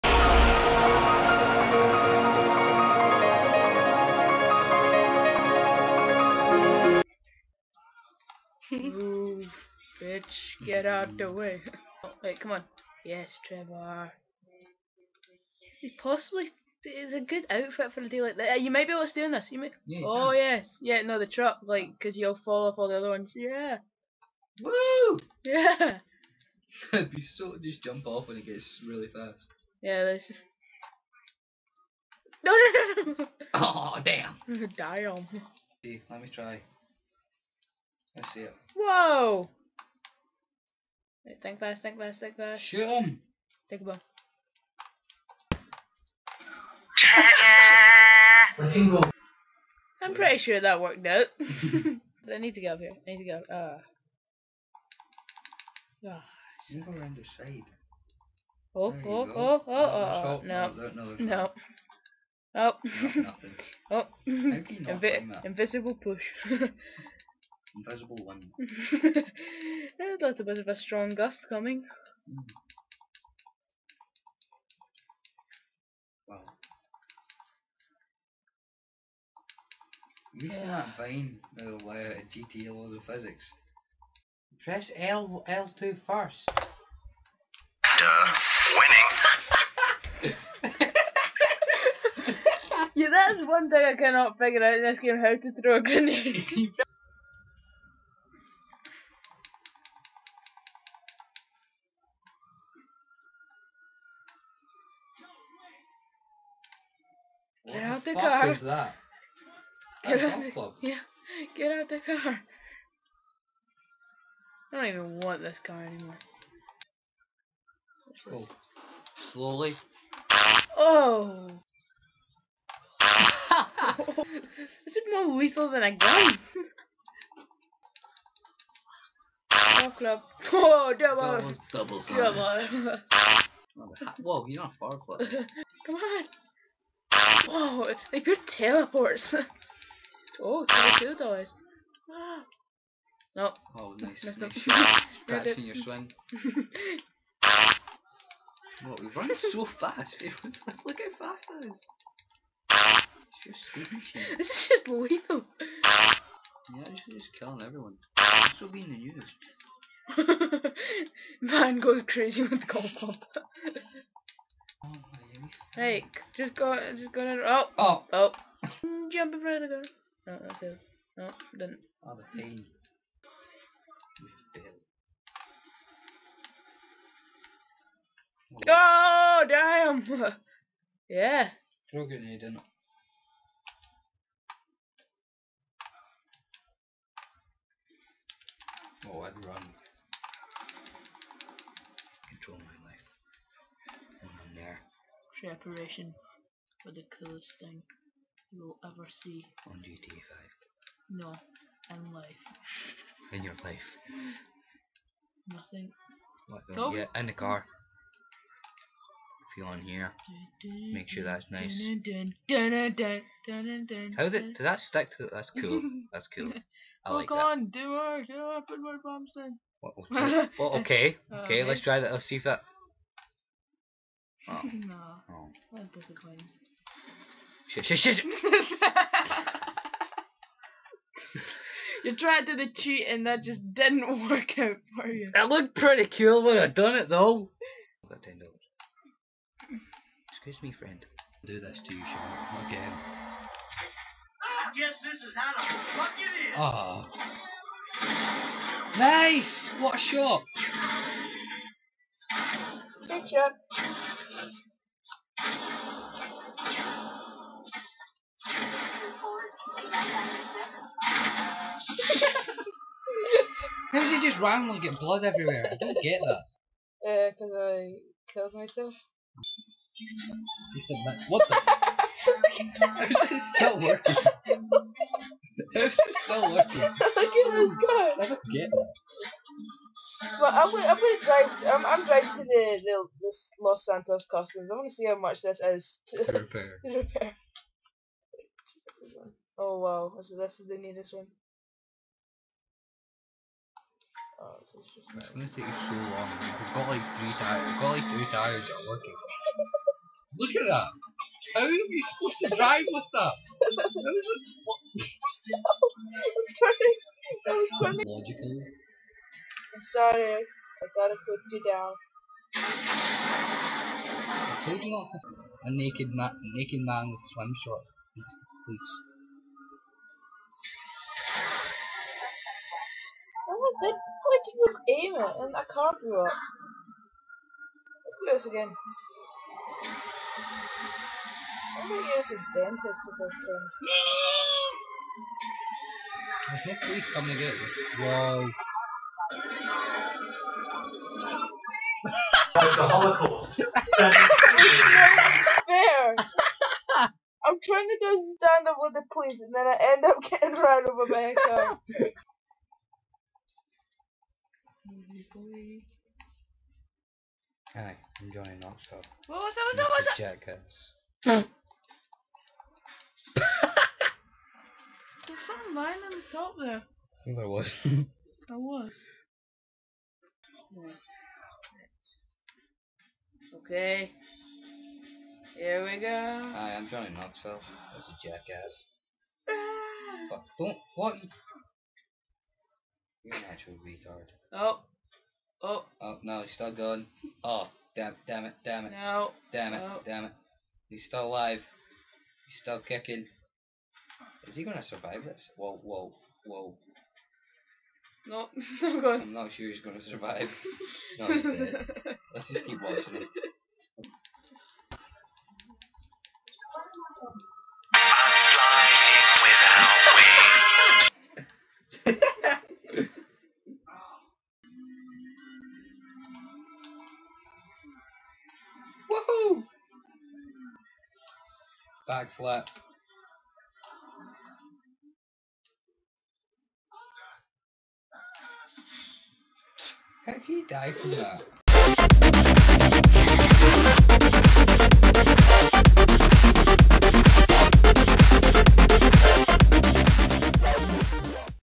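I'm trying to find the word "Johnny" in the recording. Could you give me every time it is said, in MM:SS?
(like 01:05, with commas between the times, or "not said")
05:58, 06:16.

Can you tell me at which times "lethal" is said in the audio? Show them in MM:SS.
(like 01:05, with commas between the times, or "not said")
02:05, 02:34.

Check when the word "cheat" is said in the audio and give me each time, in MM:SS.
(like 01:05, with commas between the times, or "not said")
03:52.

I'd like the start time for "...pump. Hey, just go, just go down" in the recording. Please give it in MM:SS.
02:42.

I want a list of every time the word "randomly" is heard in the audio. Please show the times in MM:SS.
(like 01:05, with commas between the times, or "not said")
04:24.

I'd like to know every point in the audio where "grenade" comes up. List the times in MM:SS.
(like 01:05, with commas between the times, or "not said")
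01:35, 03:02.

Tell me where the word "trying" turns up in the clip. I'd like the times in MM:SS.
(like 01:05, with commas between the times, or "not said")
05:47.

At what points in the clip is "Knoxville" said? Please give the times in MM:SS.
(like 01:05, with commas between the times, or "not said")
05:58, 06:17.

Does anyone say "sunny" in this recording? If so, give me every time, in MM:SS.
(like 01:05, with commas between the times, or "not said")
not said.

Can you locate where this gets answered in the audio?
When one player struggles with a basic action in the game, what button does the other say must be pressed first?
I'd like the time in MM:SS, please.
01:25.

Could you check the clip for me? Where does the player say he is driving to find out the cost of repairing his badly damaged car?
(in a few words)
Los Santos Customs.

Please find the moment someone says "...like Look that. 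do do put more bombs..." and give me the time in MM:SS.
03:37.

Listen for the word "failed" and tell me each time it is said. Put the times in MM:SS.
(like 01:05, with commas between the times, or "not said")
02:50, 02:58.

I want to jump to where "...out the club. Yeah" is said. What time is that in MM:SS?
01:50.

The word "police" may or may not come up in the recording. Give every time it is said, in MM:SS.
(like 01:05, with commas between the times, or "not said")
05:18, 05:36, 05:49.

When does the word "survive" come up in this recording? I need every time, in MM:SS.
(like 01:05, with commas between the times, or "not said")
06:34, 06:40.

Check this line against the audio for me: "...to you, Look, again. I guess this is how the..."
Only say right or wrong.
wrong.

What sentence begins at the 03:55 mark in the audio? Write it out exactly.
It looked pretty cool when I done it though.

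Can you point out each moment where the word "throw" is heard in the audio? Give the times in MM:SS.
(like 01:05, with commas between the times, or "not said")
01:35, 03:01.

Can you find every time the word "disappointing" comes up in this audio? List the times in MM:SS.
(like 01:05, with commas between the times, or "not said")
03:45.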